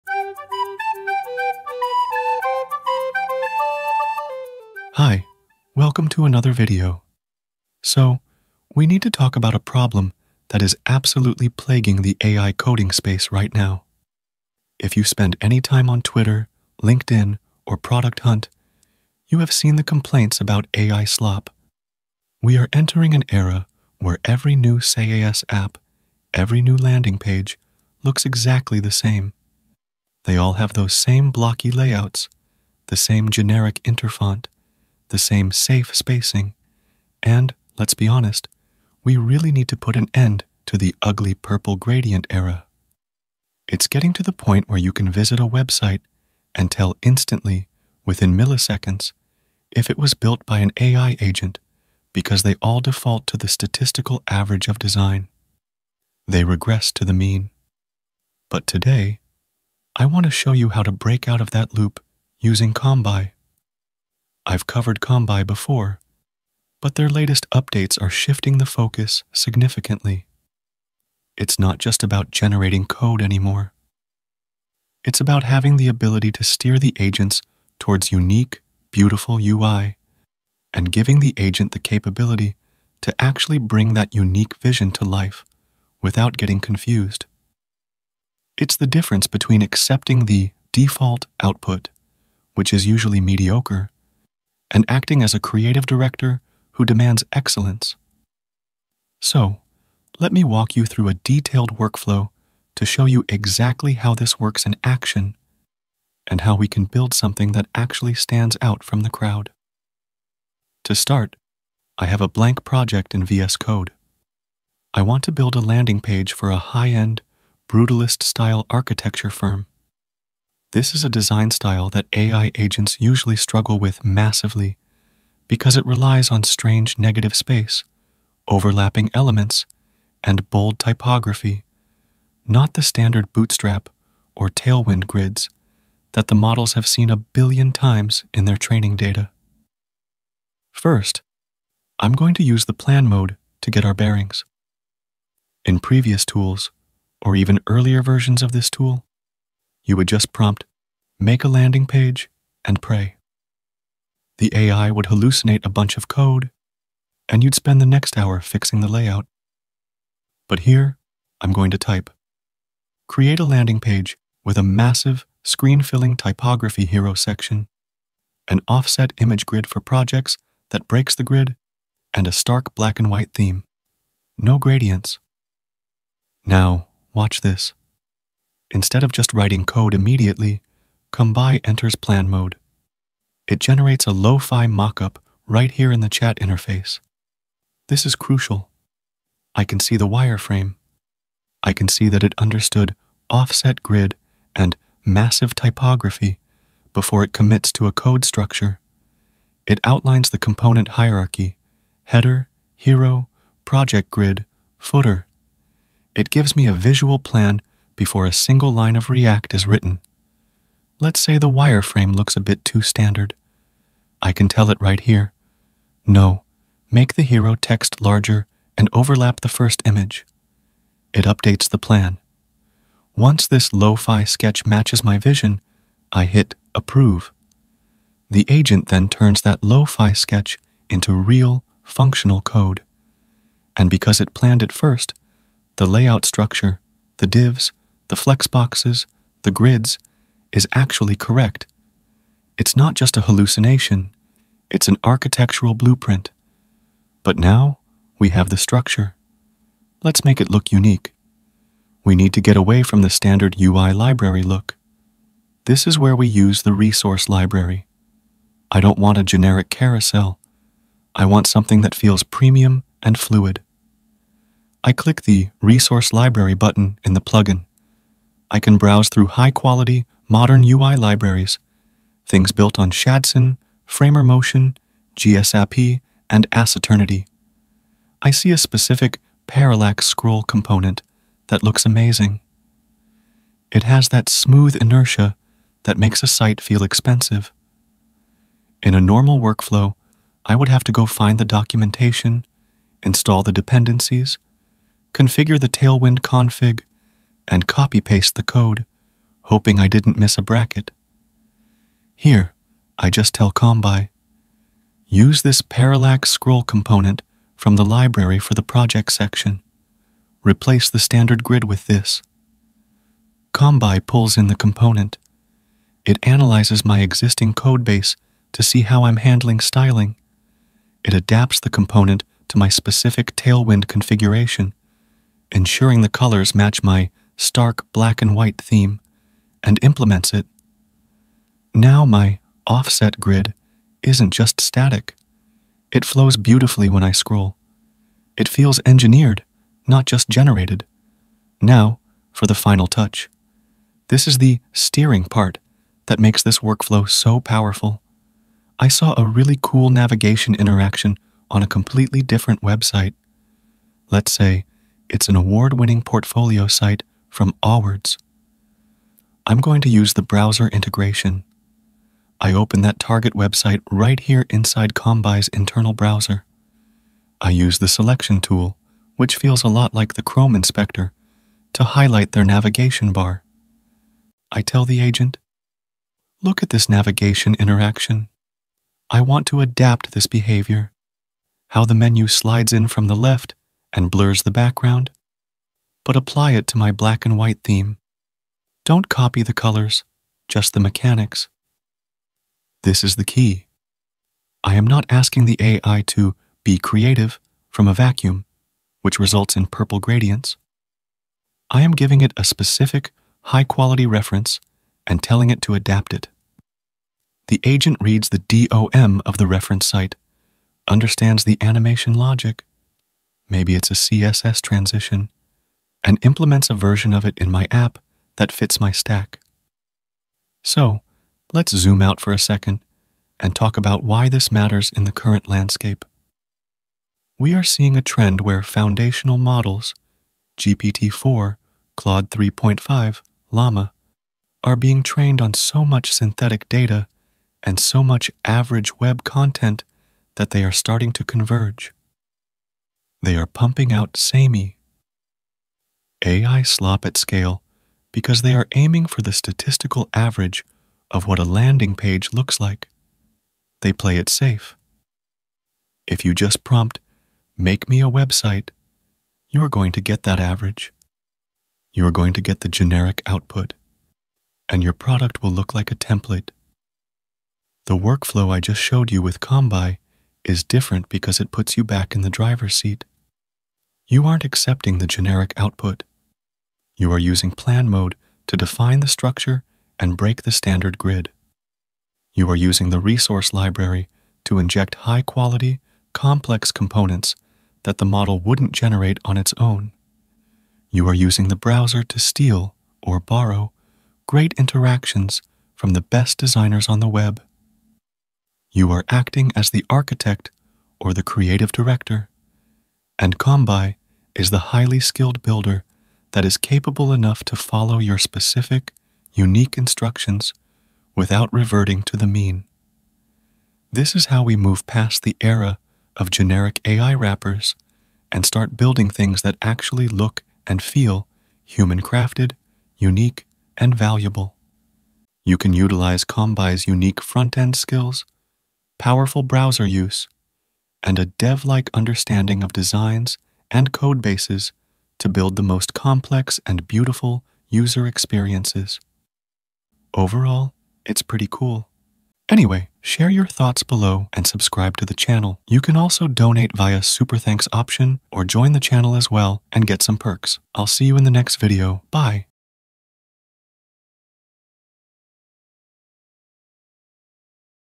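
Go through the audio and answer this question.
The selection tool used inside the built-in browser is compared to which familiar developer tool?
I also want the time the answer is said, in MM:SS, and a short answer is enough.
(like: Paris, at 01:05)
Chrome inspector, at 06:10.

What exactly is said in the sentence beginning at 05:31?
Now my offset grid isn't just static.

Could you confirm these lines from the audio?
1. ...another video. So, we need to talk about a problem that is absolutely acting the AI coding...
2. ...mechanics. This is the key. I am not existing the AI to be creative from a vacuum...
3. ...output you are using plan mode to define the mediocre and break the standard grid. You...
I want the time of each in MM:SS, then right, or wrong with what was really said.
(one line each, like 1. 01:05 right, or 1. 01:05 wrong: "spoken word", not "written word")
1. 00:06 wrong: "plaguing", not "acting"
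2. 06:30 wrong: "asking", not "existing"
3. 07:55 wrong: "structure", not "mediocre".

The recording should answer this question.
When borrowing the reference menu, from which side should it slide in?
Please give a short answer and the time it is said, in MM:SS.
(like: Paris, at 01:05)
The left, at 06:22.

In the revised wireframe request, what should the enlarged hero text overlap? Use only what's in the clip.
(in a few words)
The first image.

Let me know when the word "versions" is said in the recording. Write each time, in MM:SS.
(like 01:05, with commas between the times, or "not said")
02:28, 06:56.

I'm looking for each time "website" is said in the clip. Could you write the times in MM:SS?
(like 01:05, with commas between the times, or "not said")
00:45, 05:52, 06:03, 07:38.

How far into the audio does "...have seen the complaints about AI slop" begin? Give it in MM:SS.
00:19.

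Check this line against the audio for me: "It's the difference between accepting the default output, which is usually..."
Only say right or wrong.
right.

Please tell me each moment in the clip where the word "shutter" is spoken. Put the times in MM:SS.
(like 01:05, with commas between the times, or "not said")
not said.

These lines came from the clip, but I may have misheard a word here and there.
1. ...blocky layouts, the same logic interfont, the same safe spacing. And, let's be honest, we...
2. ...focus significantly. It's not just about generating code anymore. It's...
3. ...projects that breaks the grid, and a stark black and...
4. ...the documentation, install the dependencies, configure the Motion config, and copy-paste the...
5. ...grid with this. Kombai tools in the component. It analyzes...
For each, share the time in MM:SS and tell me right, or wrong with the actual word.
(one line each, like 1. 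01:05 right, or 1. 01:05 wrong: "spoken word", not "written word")
1. 00:31 wrong: "generic", not "logic"
2. 01:08 right
3. 02:49 right
4. 04:51 wrong: "Tailwind", not "Motion"
5. 05:11 wrong: "pulls", not "tools".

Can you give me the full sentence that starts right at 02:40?
But here, I'm going to type.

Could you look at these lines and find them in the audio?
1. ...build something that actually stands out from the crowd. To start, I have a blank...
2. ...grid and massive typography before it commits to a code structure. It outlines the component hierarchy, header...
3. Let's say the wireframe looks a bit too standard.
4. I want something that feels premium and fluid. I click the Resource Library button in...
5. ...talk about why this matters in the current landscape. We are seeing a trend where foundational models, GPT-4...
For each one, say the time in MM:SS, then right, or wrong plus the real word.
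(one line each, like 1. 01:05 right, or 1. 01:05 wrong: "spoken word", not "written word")
1. 01:46 right
2. 03:13 right
3. 03:31 right
4. 04:21 right
5. 07:03 right.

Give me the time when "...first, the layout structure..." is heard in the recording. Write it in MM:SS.
03:54.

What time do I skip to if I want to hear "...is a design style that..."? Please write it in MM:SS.
02:00.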